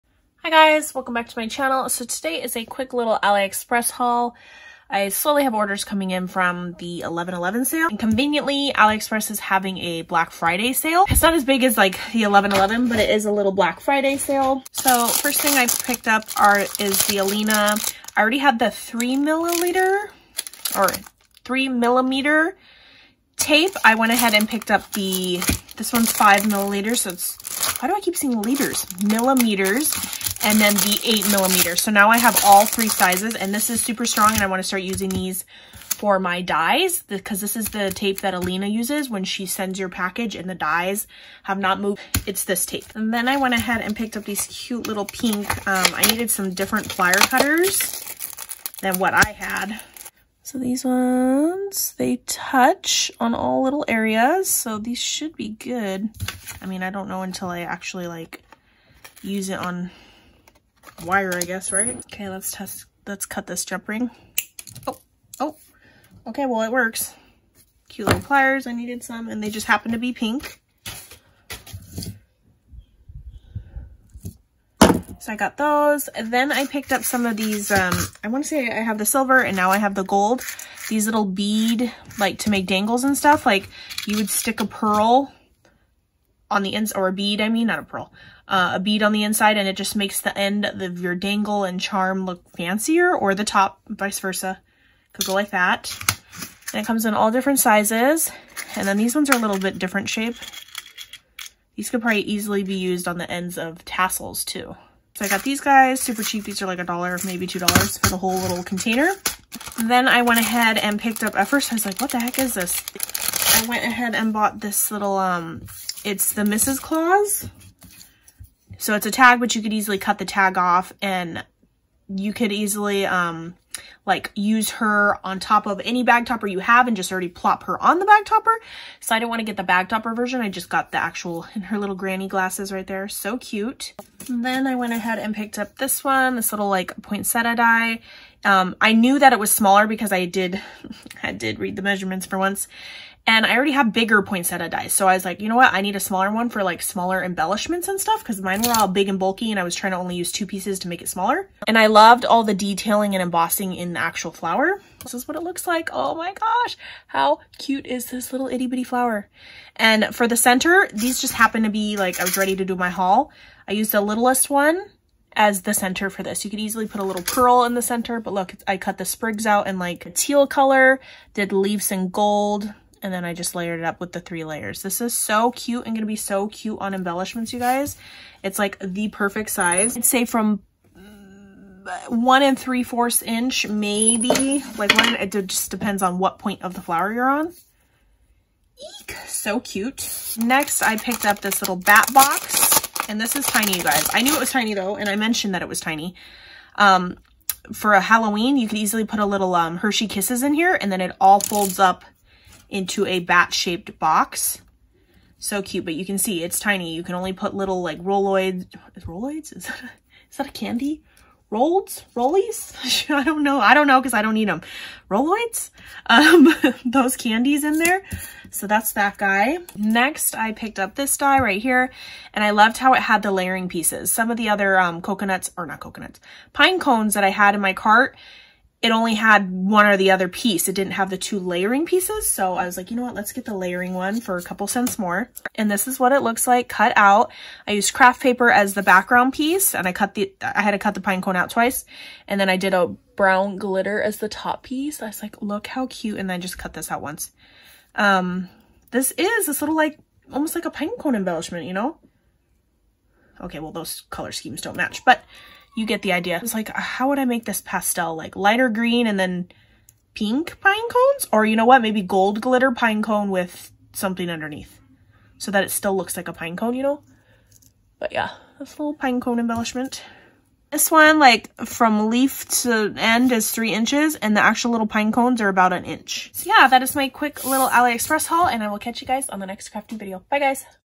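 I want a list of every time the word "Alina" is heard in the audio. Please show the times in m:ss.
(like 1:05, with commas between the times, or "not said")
0:17, 0:38.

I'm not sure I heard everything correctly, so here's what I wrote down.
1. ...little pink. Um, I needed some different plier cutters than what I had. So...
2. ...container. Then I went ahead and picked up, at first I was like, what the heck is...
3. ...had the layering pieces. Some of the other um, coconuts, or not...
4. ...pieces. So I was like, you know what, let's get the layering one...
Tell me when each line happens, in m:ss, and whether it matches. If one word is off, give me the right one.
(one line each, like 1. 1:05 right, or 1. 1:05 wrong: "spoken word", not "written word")
1. 0:44 right
2. 1:48 right
3. 3:43 right
4. 3:51 right.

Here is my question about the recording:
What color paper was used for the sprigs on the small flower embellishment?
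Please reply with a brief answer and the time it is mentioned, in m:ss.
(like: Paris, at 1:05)
teal, at 2:50.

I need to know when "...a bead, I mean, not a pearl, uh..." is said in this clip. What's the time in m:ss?
1:27.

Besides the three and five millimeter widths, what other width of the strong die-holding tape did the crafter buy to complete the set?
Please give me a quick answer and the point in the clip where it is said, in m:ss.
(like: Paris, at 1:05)
8 millimeter, at 0:31.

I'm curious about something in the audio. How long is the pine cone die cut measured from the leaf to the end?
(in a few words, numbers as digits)
3 inches.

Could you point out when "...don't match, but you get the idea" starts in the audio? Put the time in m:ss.
4:14.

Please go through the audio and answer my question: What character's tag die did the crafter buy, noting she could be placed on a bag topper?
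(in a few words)
Mrs. Claus.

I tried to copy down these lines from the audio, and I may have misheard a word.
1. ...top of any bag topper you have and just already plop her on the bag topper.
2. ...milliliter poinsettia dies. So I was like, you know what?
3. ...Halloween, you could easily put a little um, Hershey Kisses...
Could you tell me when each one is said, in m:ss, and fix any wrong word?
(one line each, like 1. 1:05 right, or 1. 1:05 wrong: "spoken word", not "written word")
1. 2:05 right
2. 2:23 wrong: "bigger", not "milliliter"
3. 3:17 right.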